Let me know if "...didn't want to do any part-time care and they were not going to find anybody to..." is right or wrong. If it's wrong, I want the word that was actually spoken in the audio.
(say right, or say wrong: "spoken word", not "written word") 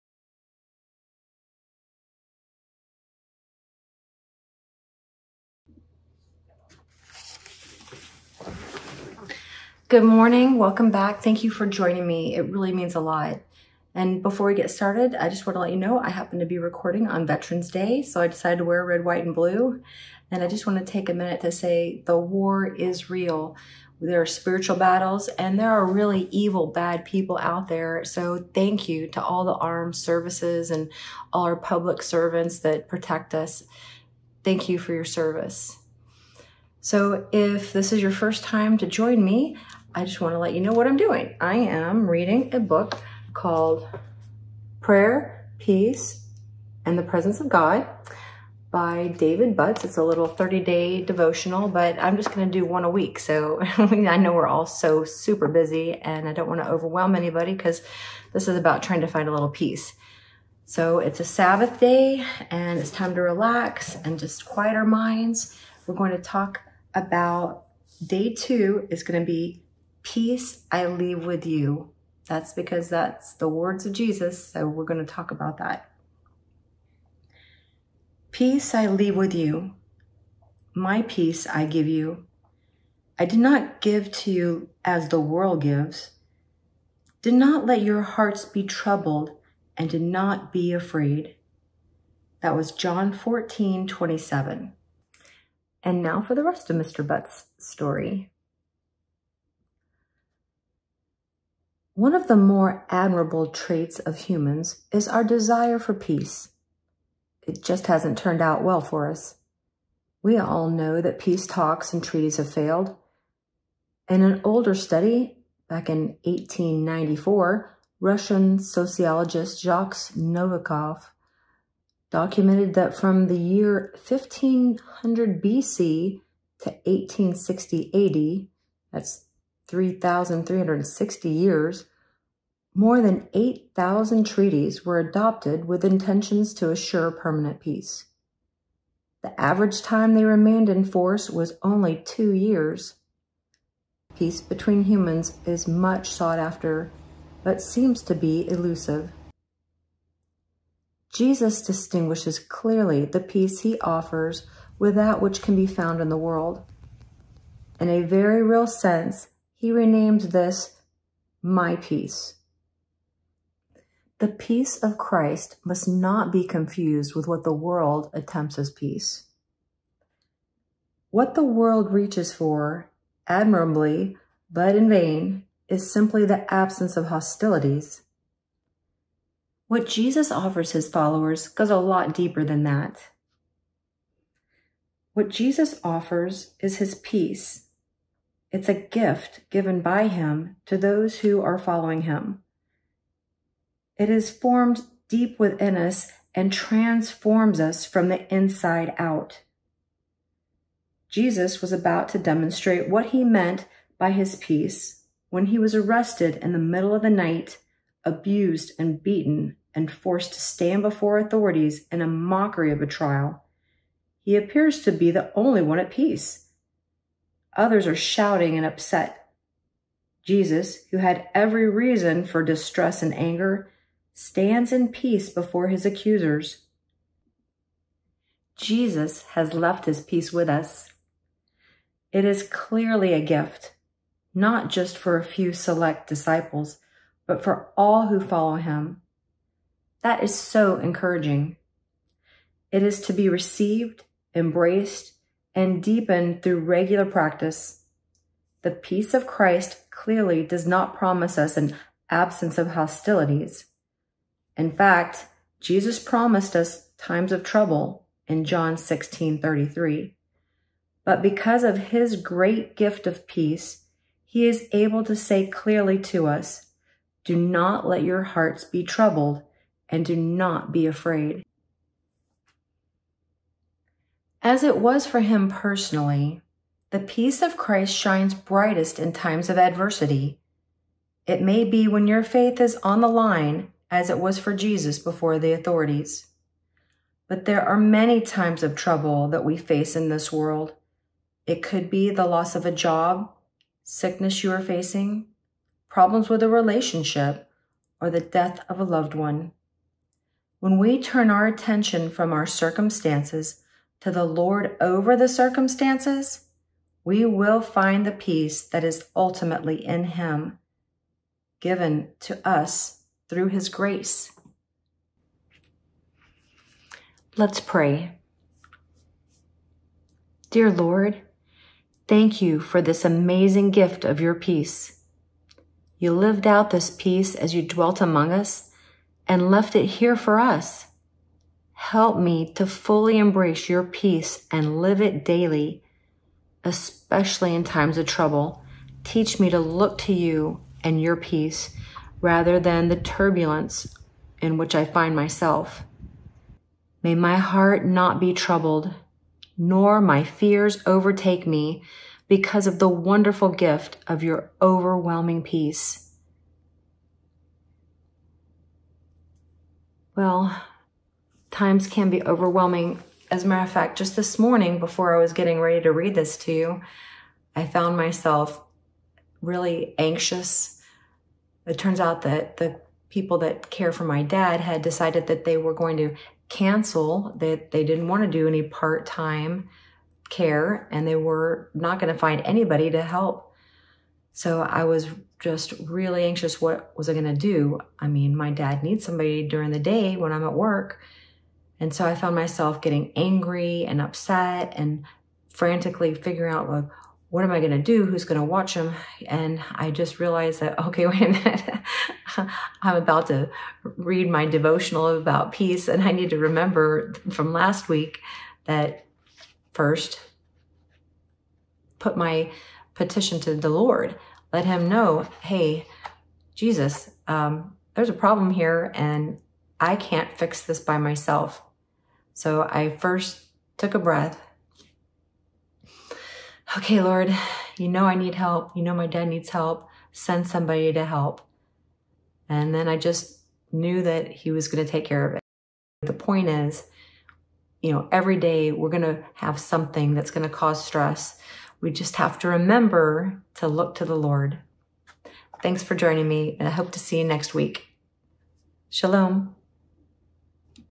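right.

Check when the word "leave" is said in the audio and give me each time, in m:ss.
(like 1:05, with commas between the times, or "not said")
1:10, 1:18.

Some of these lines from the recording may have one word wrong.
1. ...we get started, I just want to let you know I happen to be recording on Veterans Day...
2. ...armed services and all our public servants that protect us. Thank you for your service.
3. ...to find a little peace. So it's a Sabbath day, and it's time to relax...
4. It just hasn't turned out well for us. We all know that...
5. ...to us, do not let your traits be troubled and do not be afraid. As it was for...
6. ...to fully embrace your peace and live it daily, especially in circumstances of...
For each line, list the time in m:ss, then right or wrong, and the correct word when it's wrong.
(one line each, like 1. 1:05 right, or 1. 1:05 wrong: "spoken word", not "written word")
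1. 0:14 right
2. 0:29 right
3. 0:59 right
4. 1:47 right
5. 4:26 wrong: "hearts", not "traits"
6. 5:32 wrong: "times", not "circumstances".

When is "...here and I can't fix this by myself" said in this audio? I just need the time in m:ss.
6:58.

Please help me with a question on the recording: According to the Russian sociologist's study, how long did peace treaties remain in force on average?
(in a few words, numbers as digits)
2 years.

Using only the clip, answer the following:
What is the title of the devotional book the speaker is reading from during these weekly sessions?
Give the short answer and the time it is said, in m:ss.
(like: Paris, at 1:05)
Prayer, Peace, and the Presence of God, at 0:44.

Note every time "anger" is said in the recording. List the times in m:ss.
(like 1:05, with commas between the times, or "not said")
3:43.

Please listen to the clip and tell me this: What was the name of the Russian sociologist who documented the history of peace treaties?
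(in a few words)
Jacques Novikov.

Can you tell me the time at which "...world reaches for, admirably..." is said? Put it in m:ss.
2:51.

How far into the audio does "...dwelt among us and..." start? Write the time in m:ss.
5:27.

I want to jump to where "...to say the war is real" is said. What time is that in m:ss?
0:21.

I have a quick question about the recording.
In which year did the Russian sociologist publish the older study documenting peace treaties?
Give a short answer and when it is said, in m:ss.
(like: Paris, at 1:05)
1894, at 1:56.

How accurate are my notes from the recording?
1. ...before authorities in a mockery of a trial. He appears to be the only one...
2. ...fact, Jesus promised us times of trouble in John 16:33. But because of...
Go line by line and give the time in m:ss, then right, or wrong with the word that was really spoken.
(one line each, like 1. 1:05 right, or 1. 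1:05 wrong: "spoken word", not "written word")
1. 3:30 right
2. 4:14 right.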